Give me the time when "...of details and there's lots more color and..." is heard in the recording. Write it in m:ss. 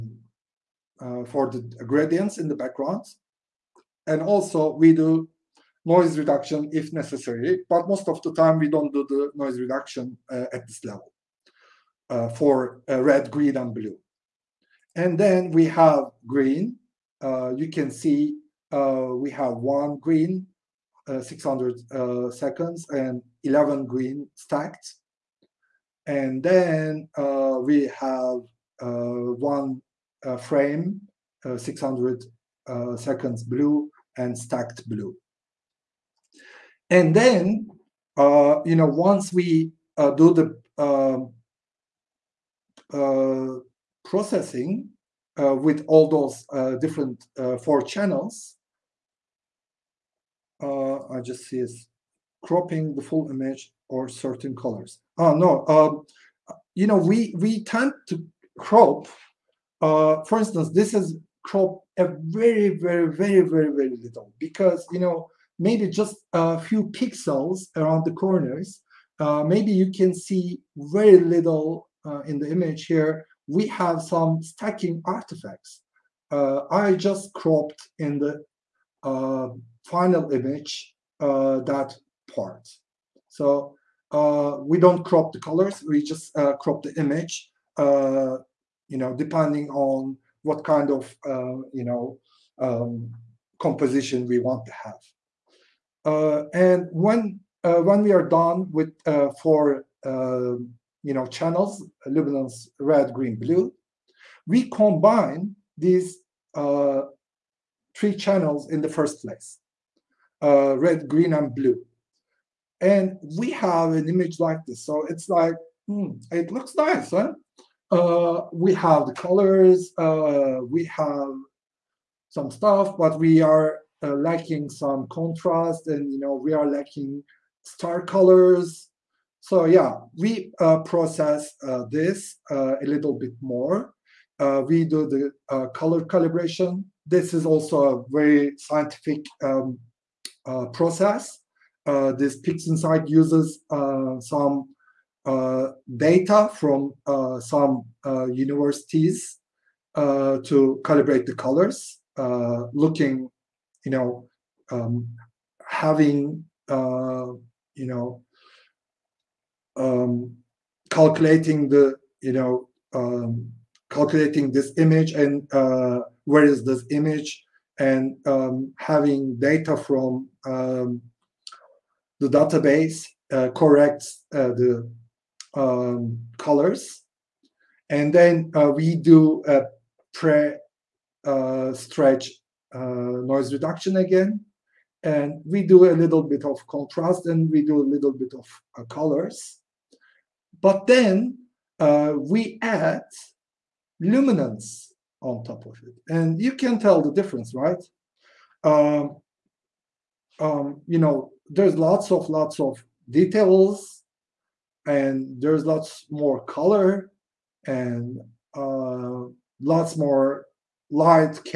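3:22.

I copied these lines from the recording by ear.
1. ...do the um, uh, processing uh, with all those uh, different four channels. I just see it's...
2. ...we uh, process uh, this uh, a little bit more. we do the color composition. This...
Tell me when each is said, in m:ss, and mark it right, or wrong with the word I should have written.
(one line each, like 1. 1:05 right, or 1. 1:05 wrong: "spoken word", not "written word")
1. 0:40 right
2. 2:10 wrong: "calibration", not "composition".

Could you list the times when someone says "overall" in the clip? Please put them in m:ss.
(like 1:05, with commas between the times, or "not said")
not said.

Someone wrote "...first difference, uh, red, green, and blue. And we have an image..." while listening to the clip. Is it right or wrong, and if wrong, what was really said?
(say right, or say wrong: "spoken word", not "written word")
wrong: "place", not "difference".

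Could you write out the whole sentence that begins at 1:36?
and when when we are done with for you know, channels, luminance red, green, blue.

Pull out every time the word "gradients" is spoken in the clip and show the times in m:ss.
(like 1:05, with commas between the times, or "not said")
0:01.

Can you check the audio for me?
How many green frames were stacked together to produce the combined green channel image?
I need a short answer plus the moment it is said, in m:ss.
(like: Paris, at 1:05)
11, at 0:23.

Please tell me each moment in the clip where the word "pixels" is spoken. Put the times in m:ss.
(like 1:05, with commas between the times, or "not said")
1:06.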